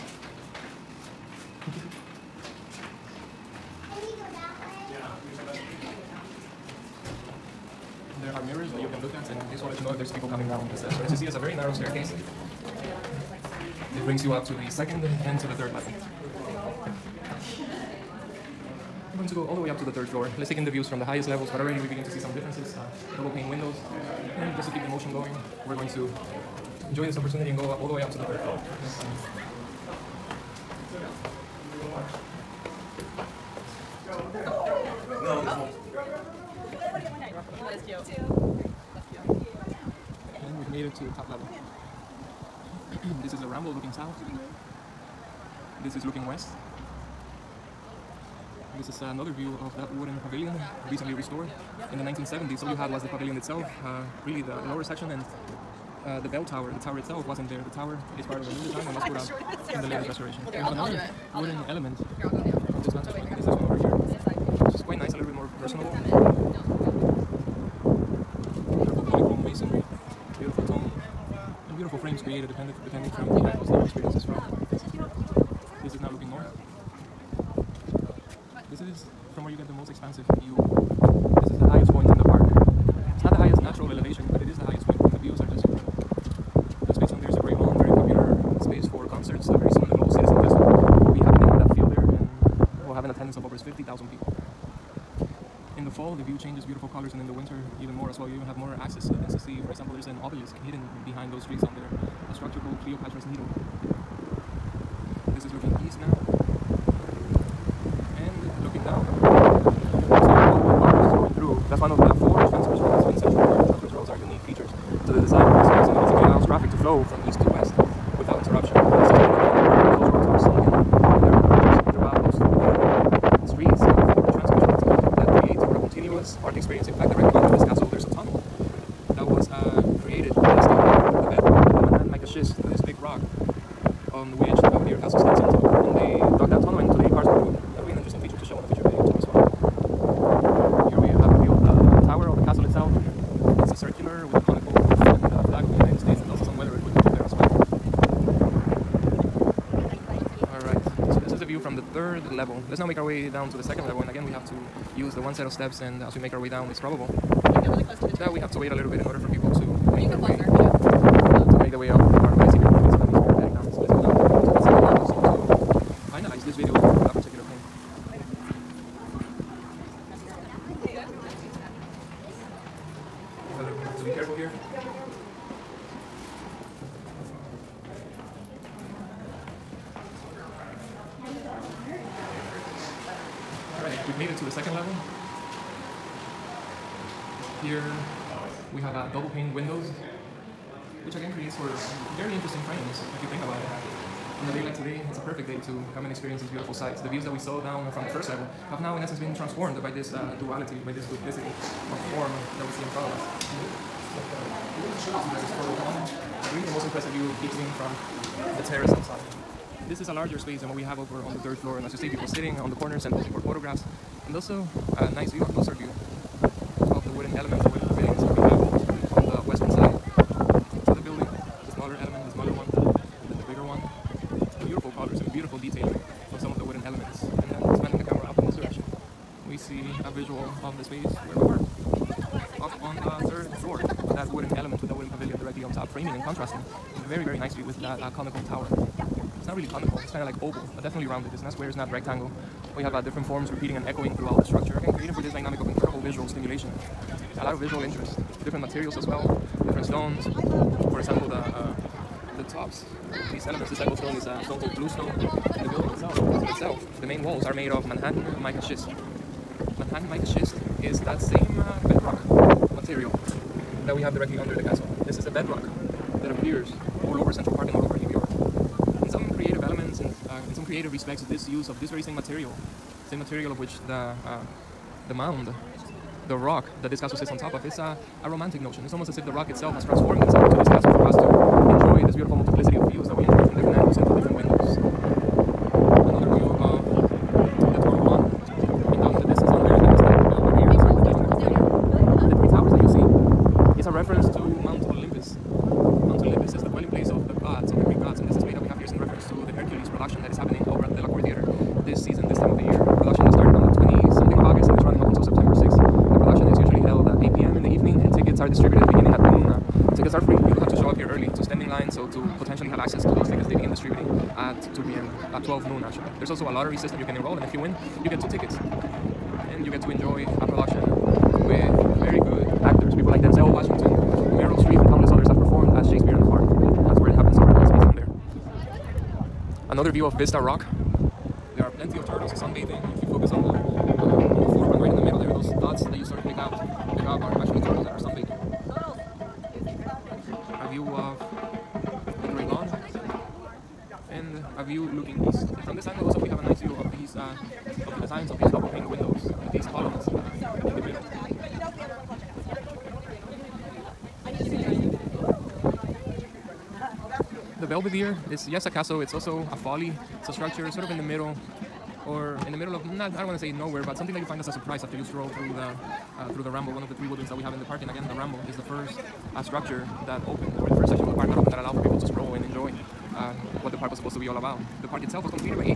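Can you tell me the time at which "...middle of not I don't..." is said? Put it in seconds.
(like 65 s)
362 s.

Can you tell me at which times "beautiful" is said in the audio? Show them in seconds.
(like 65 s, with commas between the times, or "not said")
71 s, 96 s, 196 s, 282 s.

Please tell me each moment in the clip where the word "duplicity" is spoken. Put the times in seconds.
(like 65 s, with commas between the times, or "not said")
201 s.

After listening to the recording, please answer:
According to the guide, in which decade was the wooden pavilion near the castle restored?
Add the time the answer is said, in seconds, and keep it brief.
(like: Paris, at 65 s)
1970s, at 52 s.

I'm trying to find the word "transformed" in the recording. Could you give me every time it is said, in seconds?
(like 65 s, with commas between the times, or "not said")
199 s, 279 s.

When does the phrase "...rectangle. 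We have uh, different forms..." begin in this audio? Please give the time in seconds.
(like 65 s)
241 s.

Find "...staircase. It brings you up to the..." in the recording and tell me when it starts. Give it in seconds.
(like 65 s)
11 s.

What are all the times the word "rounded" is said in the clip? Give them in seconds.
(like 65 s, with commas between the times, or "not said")
241 s.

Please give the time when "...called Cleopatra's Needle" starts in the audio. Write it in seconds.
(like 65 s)
102 s.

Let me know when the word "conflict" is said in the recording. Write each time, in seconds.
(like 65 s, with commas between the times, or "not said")
not said.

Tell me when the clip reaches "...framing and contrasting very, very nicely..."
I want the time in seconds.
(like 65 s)
236 s.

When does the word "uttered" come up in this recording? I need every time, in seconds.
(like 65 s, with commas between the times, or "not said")
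not said.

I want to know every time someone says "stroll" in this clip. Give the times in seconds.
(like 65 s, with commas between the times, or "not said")
365 s, 372 s.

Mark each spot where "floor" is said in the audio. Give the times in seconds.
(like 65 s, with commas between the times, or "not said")
20 s, 28 s, 211 s.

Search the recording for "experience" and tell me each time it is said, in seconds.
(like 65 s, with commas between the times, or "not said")
73 s, 196 s.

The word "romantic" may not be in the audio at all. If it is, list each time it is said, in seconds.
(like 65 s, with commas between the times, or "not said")
278 s.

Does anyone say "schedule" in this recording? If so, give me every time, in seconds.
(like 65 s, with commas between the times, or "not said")
not said.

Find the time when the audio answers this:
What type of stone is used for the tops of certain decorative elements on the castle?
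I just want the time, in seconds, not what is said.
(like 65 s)
254 s.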